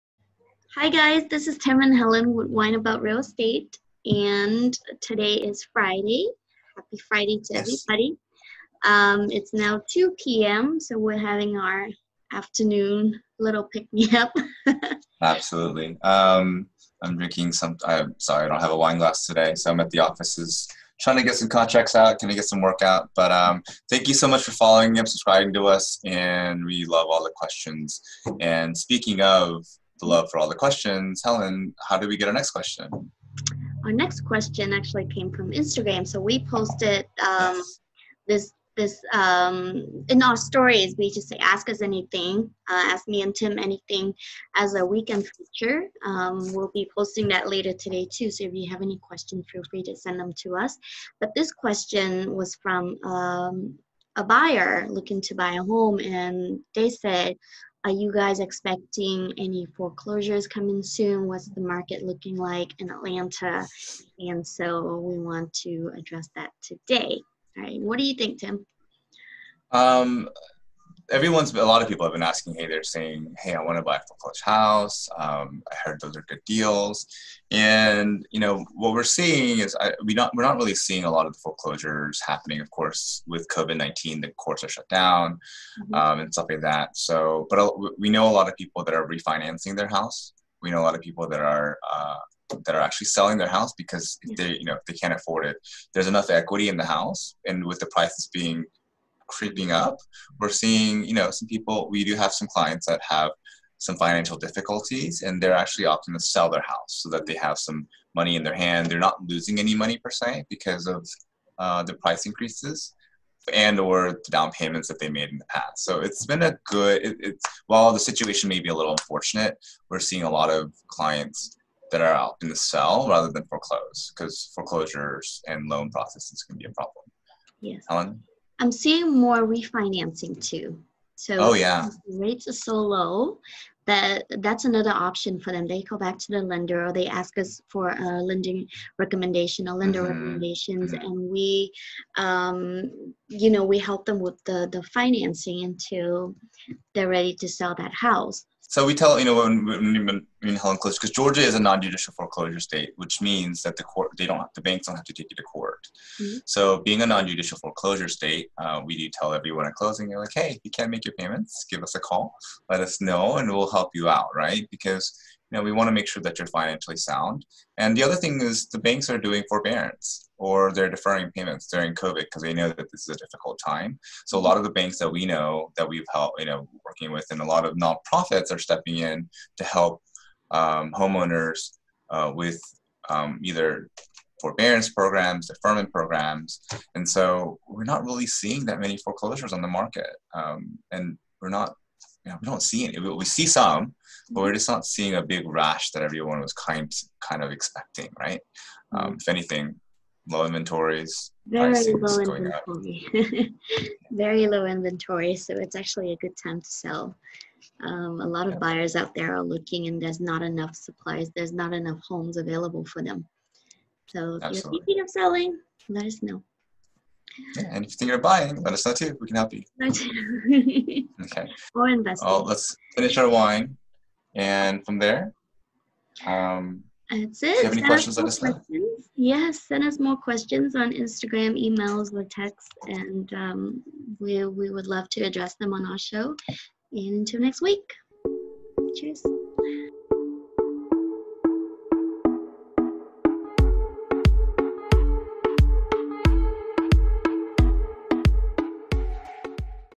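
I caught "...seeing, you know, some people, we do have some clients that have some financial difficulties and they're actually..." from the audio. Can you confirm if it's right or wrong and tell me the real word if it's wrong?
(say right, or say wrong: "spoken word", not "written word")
right.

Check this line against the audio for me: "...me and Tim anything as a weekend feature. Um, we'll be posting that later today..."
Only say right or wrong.
right.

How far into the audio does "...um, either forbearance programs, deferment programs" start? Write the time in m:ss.
3:03.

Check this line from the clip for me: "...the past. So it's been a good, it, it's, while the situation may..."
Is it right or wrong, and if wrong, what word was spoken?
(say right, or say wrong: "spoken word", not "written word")
right.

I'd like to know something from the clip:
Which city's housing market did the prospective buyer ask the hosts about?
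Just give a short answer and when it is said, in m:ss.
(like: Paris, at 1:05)
Atlanta, at 1:02.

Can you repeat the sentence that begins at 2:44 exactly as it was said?
Because you know we want to make sure that you're financially sound.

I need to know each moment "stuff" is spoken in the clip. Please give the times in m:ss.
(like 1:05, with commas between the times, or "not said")
1:26.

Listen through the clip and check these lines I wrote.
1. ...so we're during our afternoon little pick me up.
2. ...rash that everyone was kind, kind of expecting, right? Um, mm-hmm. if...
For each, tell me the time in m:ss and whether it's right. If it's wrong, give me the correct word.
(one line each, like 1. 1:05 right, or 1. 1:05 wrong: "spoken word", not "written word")
1. 0:10 wrong: "having", not "during"
2. 3:15 right.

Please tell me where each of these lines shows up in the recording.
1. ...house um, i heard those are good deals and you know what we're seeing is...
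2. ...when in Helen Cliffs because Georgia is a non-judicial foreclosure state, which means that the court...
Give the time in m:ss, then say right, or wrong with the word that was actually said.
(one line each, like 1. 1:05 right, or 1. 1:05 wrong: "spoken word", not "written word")
1. 1:14 right
2. 2:29 right.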